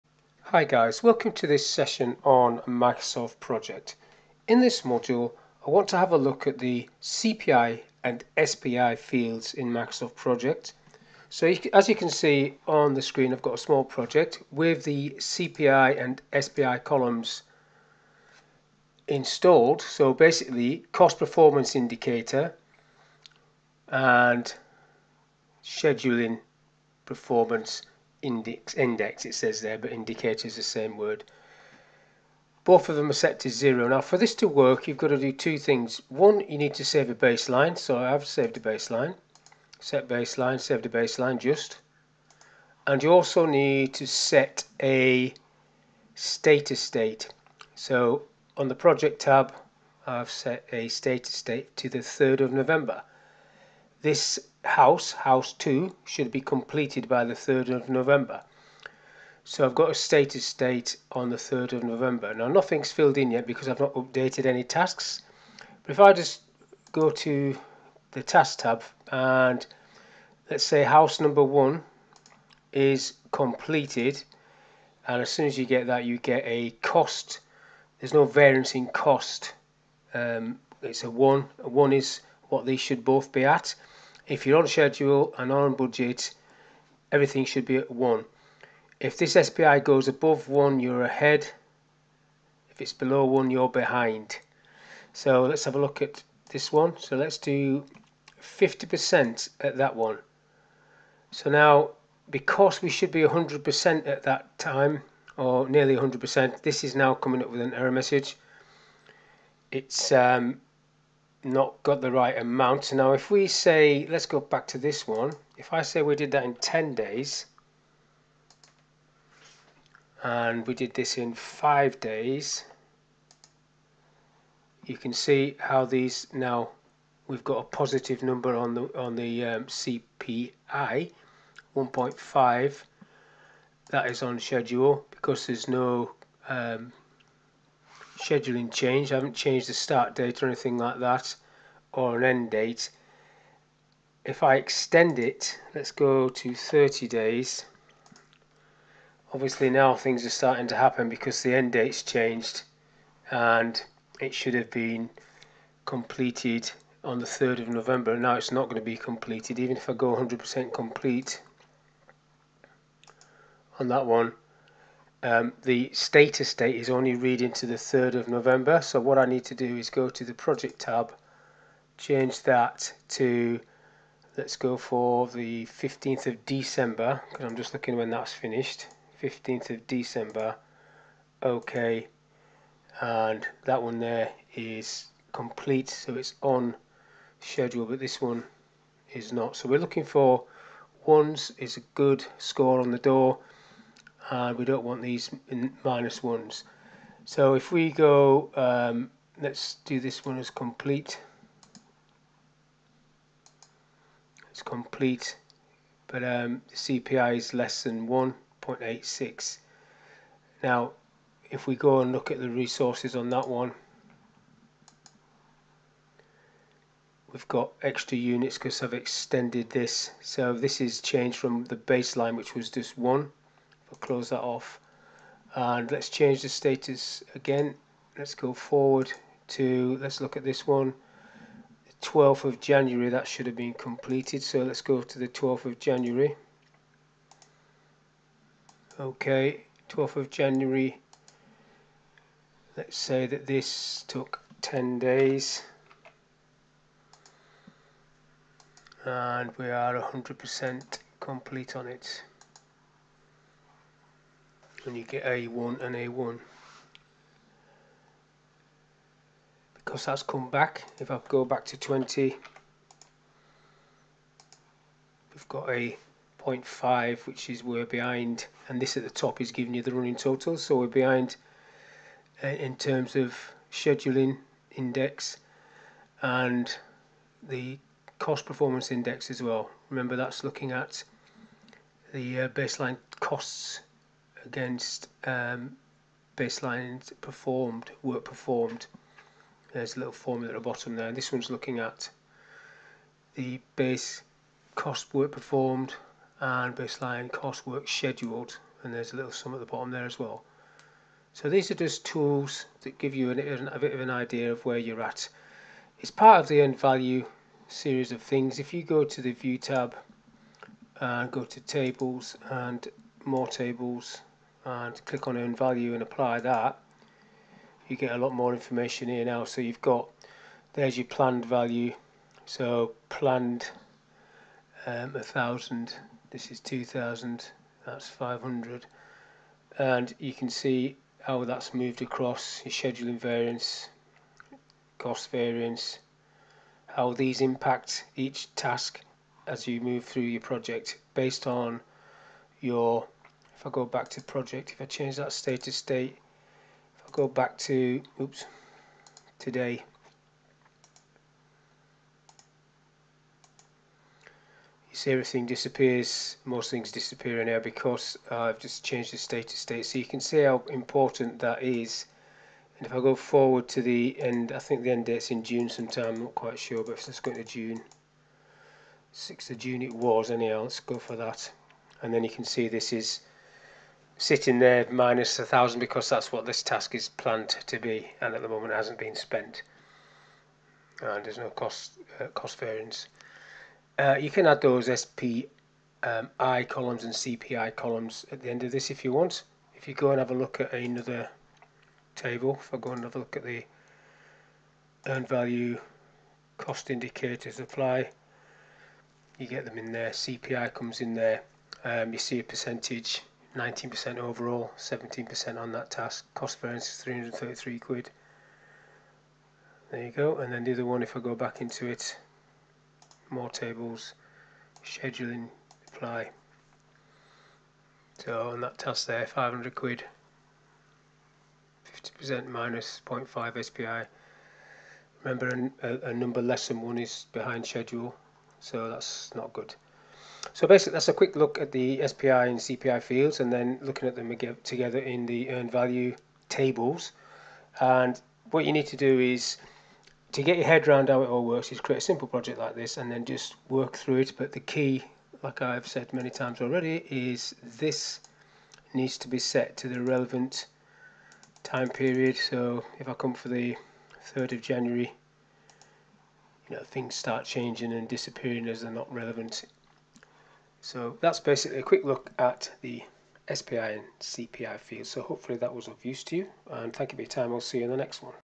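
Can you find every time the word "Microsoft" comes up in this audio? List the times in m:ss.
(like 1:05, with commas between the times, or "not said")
0:02, 0:09.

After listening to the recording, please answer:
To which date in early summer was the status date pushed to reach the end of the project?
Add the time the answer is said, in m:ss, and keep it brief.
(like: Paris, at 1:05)
6th of June, at 6:09.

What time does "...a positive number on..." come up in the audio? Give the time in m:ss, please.
2:07.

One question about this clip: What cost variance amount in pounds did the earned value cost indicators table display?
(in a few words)
333.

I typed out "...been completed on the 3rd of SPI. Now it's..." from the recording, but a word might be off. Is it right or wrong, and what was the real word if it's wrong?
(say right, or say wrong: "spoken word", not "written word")
wrong: "November", not "SPI".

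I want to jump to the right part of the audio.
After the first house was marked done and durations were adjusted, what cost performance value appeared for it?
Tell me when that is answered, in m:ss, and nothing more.
2:11.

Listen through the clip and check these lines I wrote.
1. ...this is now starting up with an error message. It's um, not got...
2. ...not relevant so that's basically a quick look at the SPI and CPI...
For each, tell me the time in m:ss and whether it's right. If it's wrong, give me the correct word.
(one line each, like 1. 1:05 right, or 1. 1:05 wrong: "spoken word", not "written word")
1. 1:46 wrong: "coming", not "starting"
2. 7:38 right.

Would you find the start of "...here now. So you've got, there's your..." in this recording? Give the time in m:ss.
5:19.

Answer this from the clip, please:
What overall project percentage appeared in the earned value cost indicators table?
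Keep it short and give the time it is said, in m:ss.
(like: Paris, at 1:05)
19%, at 6:43.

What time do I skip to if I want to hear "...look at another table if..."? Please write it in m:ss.
6:30.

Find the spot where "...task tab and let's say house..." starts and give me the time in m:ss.
1:08.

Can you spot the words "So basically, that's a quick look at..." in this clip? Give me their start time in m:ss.
7:10.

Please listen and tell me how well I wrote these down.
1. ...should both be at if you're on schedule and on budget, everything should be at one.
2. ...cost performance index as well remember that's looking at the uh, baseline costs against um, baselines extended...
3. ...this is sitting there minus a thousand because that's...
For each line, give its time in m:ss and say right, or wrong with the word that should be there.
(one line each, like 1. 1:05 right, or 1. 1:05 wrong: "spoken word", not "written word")
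1. 1:22 right
2. 4:38 wrong: "performed", not "extended"
3. 6:12 right.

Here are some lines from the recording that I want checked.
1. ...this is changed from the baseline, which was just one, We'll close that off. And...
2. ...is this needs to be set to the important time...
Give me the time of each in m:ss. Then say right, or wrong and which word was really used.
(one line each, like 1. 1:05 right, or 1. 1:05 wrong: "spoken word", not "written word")
1. 3:40 right
2. 7:27 wrong: "relevant", not "important".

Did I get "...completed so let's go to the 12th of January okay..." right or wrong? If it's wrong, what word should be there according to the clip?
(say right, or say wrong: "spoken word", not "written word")
right.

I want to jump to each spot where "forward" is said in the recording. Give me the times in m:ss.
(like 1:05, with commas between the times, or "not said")
3:48, 6:03.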